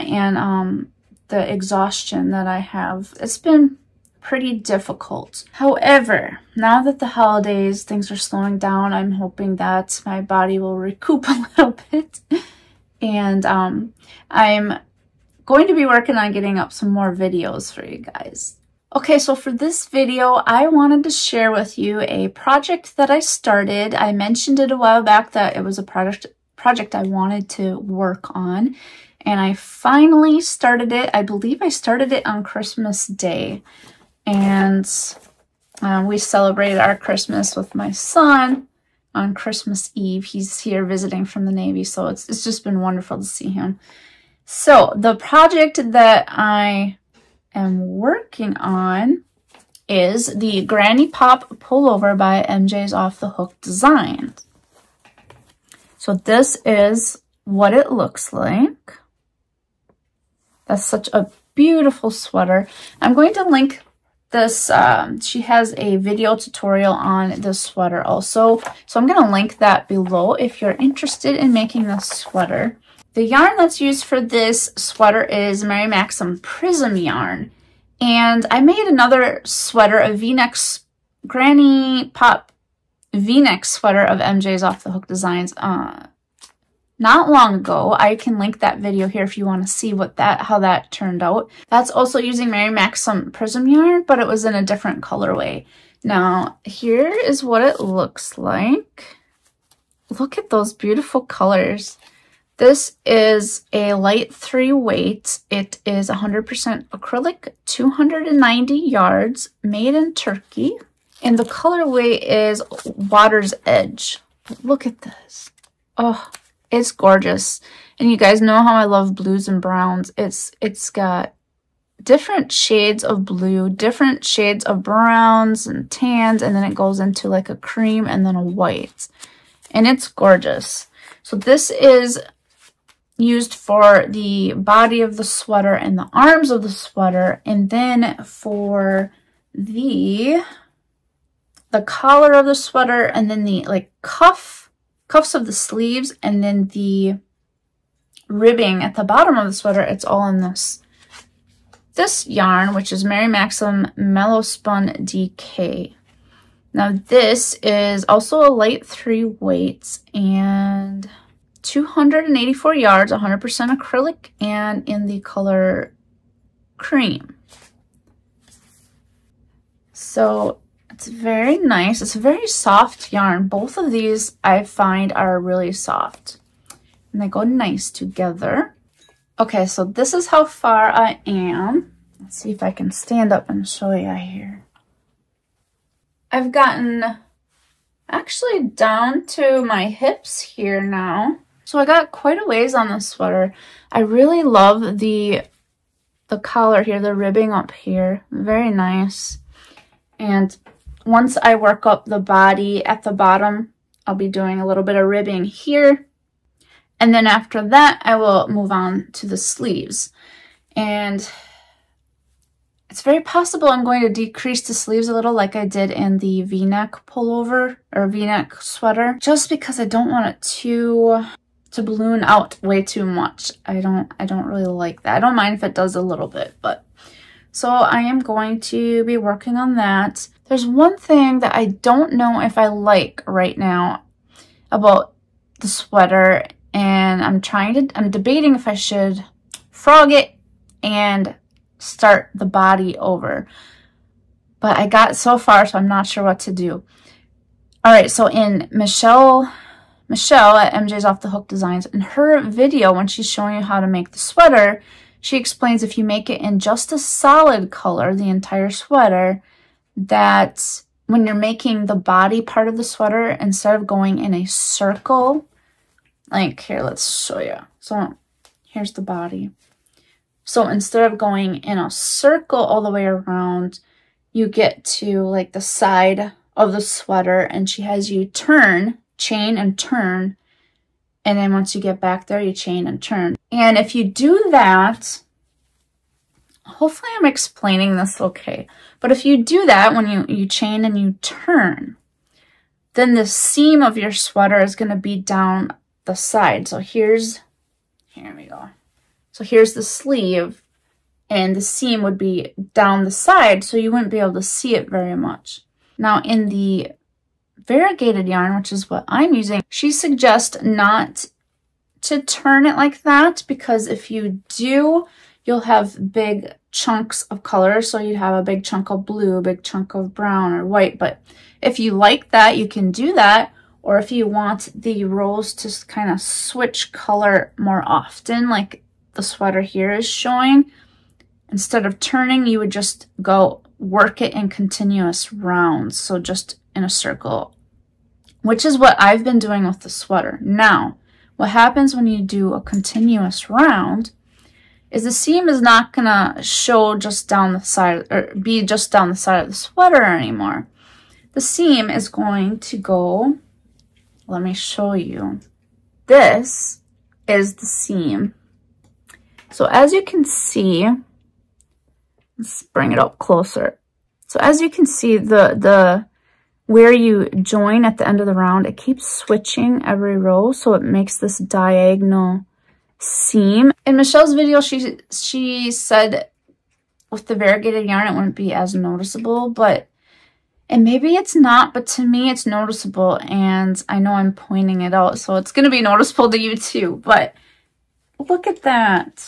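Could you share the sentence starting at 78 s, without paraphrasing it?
And I made another sweater, a v-neck granny pop v-neck sweater of MJ's Off the Hook Designs uh, not long ago.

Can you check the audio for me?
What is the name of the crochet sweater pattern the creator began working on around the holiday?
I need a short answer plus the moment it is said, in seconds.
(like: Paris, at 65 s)
Granny Pop Pullover, at 50 s.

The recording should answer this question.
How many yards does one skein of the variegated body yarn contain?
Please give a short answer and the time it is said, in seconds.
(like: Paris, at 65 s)
290, at 107 s.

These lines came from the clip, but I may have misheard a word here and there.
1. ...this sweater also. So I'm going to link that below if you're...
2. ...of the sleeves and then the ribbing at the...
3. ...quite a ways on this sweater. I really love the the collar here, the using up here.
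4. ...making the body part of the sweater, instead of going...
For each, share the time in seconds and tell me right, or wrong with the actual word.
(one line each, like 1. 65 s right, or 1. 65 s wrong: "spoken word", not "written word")
1. 67 s right
2. 145 s right
3. 192 s wrong: "ribbing", not "using"
4. 261 s right.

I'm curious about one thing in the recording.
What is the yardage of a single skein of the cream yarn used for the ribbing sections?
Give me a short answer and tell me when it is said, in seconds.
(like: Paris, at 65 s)
284, at 161 s.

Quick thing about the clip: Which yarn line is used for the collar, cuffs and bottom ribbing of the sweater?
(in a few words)
Mary Maxim Mellowspun DK.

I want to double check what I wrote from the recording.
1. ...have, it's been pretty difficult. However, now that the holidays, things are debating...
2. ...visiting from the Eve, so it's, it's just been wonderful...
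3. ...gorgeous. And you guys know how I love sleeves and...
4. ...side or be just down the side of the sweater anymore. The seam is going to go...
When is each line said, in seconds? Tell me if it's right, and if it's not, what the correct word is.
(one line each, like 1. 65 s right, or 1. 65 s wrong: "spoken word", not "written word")
1. 2 s wrong: "slowing", not "debating"
2. 40 s wrong: "Navy", not "Eve"
3. 116 s wrong: "blues", not "sleeves"
4. 347 s right.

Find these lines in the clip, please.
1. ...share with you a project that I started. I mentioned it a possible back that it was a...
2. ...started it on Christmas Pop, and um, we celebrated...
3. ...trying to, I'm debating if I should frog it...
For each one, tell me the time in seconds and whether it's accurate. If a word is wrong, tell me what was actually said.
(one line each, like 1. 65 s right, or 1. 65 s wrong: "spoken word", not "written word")
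1. 21 s wrong: "while", not "possible"
2. 31 s wrong: "Day", not "Pop"
3. 237 s right.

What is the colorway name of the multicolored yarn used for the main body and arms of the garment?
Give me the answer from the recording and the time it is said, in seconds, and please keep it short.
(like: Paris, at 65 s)
Water's Edge, at 112 s.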